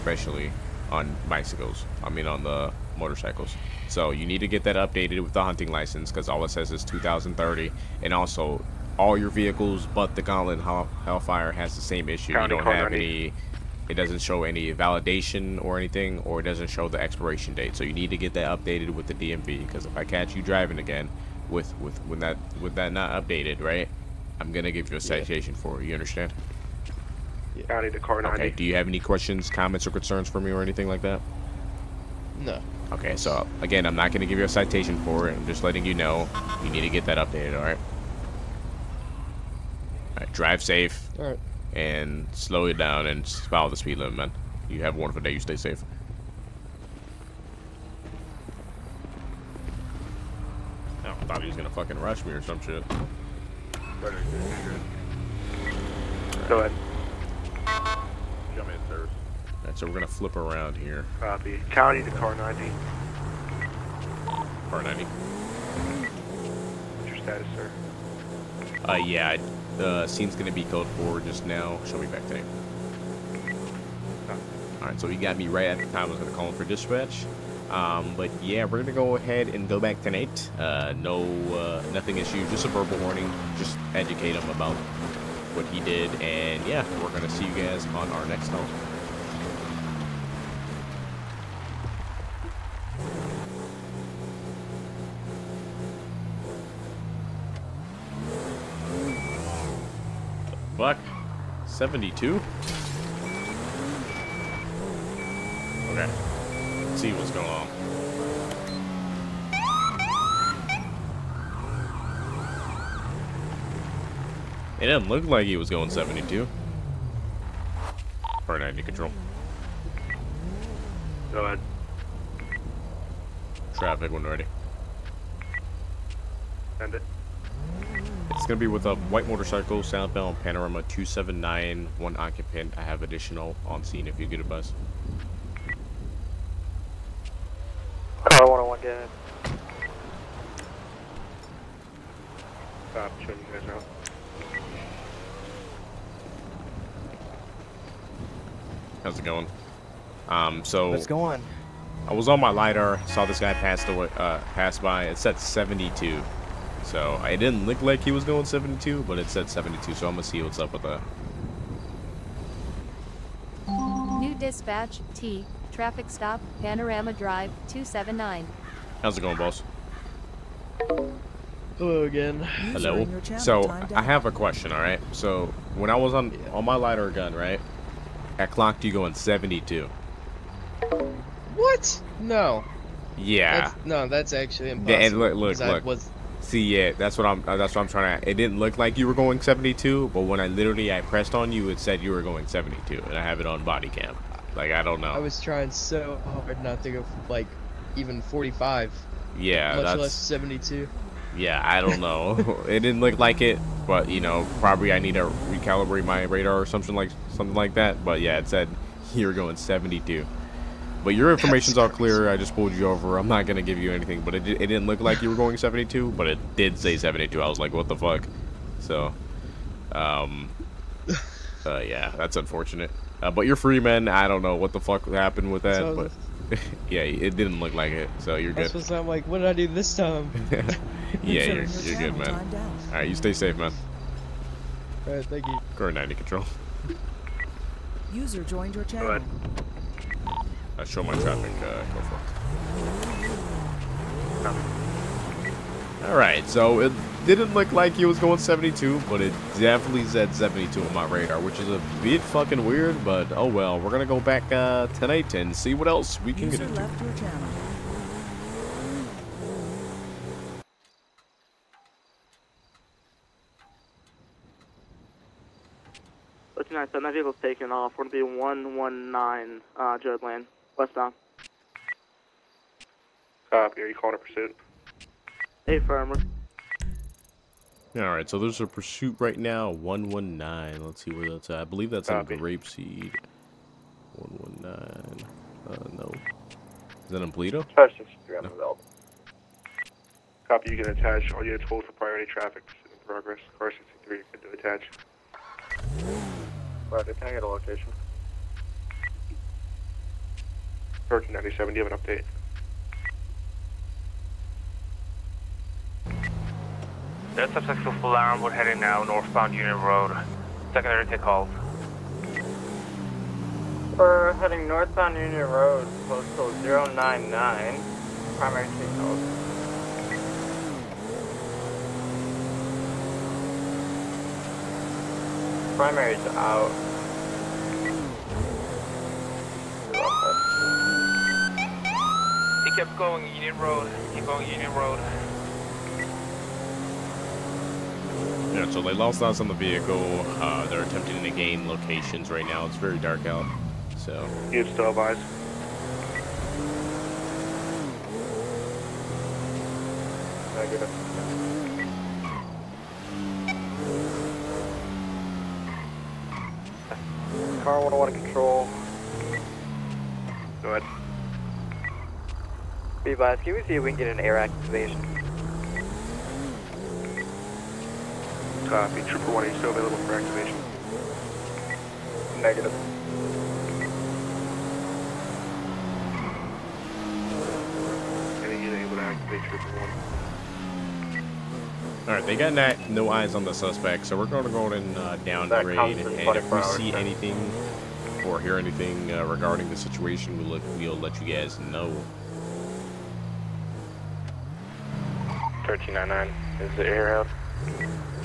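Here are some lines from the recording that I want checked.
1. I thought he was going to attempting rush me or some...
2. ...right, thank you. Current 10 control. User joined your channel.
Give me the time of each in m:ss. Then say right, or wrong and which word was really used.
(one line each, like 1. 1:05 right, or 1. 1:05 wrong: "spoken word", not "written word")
1. 0:51 wrong: "fucking", not "attempting"
2. 3:55 wrong: "90", not "10".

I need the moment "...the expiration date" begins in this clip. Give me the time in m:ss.
0:16.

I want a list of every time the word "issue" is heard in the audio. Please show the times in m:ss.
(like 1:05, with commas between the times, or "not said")
0:12, 1:22.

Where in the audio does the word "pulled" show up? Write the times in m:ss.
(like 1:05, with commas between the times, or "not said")
3:32.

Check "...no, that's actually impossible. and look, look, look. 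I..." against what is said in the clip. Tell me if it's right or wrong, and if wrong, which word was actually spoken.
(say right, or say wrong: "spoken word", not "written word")
right.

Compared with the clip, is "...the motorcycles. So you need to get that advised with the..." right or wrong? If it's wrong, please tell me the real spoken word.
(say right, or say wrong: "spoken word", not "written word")
wrong: "updated", not "advised".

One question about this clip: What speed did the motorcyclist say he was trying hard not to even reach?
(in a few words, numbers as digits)
45.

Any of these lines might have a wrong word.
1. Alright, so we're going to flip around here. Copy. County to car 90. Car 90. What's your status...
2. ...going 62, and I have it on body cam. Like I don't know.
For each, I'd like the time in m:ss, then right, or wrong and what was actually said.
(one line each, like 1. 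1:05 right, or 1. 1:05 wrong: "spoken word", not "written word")
1. 0:59 right
2. 3:12 wrong: "72", not "62".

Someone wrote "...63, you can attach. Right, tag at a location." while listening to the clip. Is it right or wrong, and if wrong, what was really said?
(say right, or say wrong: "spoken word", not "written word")
right.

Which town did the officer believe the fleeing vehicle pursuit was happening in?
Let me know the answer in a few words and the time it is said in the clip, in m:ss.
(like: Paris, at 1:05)
Grapeseed, at 4:42.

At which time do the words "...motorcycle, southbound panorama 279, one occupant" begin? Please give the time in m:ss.
2:09.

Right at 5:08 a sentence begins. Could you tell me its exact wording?
We're heading now northbound Union Road.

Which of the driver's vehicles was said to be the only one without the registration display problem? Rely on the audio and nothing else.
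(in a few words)
Gauntlet Hellfire.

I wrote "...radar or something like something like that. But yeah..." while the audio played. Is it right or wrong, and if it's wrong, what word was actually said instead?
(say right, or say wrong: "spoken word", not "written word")
right.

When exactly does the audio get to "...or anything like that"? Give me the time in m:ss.
0:30.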